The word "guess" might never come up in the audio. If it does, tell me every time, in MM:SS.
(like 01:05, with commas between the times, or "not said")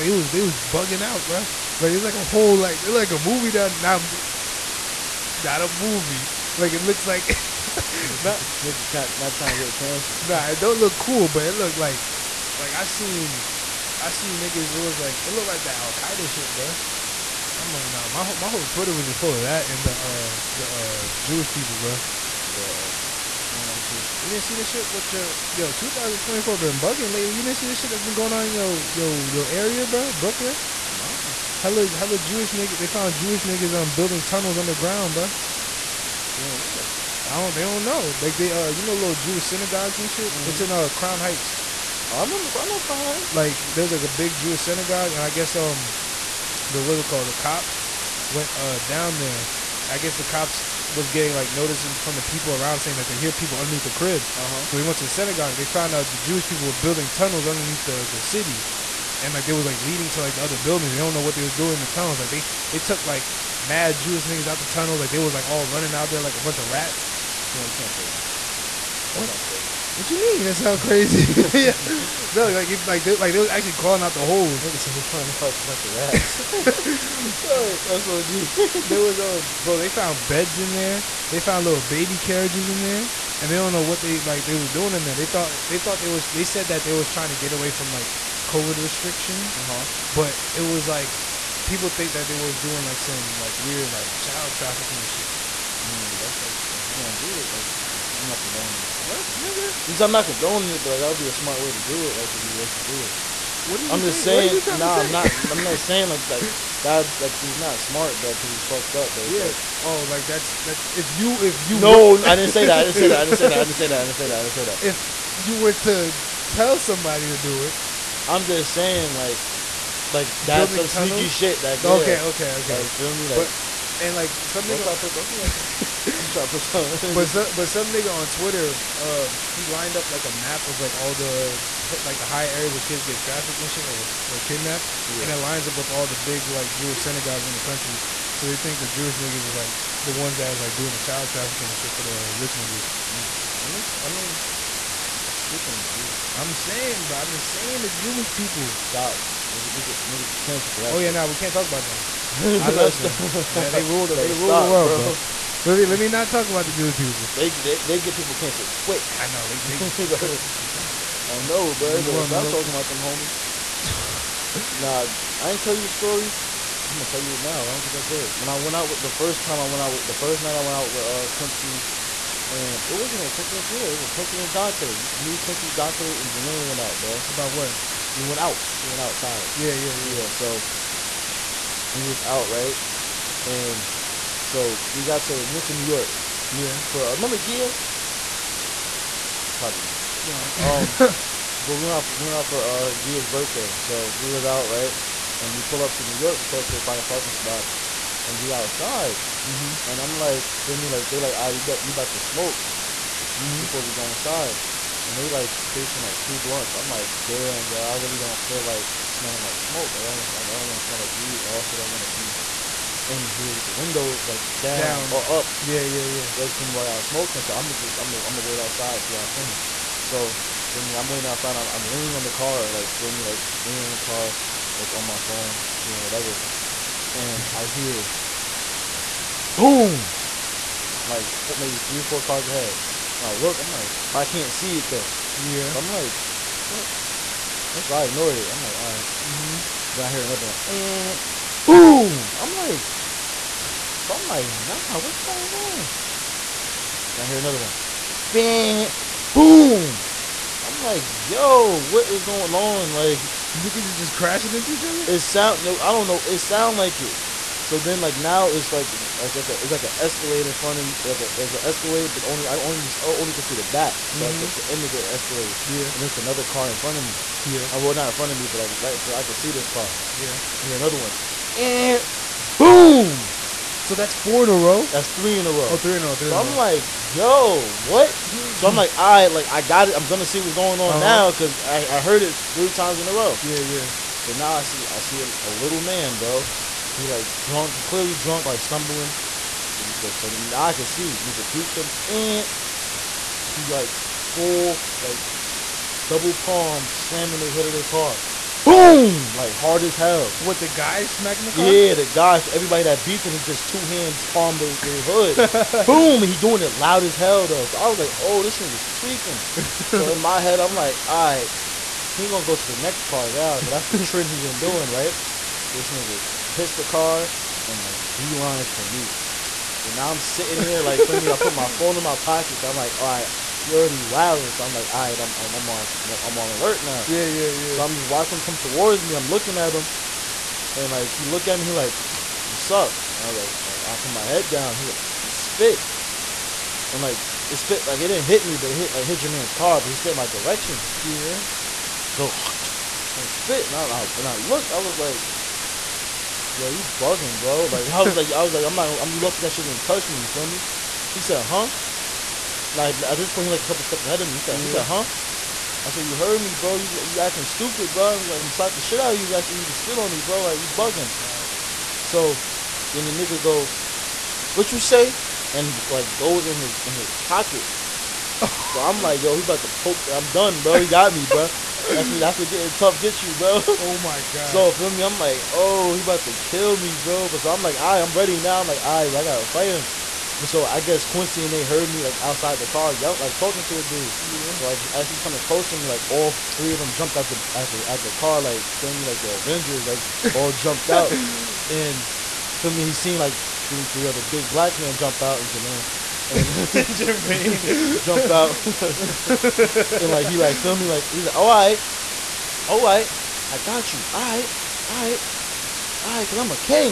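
00:45, 00:49, 06:20.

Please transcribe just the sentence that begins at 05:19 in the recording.
So now I'm sitting here, like, feel me?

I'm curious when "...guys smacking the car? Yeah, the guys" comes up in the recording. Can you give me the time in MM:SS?
05:00.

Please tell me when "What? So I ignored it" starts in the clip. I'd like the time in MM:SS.
03:57.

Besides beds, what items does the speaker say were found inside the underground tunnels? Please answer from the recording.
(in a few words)
baby carriages.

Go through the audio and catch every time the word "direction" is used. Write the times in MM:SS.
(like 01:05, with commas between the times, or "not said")
05:40.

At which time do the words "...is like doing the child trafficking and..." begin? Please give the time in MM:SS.
02:20.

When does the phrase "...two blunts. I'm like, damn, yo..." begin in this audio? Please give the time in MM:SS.
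03:26.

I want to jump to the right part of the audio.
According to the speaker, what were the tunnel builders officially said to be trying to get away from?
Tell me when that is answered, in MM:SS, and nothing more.
01:28.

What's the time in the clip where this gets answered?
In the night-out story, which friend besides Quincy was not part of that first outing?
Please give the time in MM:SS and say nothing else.
02:53.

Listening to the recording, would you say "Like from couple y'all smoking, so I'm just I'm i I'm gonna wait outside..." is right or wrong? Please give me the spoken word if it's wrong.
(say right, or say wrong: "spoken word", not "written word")
wrong: "while", not "couple".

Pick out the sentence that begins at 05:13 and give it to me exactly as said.
Cause that's the trend he been doing, right?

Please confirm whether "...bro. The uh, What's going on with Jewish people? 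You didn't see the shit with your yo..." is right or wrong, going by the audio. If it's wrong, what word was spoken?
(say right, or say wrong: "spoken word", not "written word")
right.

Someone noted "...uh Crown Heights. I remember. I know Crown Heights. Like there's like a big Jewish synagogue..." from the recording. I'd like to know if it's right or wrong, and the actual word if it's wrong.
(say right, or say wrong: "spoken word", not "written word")
right.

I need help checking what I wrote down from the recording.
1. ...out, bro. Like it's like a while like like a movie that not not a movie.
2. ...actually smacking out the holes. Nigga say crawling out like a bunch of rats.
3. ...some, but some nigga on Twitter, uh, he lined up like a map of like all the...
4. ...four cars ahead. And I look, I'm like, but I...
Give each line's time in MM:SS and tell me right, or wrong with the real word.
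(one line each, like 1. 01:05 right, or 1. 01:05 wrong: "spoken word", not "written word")
1. 00:01 wrong: "whole", not "while"
2. 01:13 wrong: "crawling", not "smacking"
3. 02:07 right
4. 03:52 right.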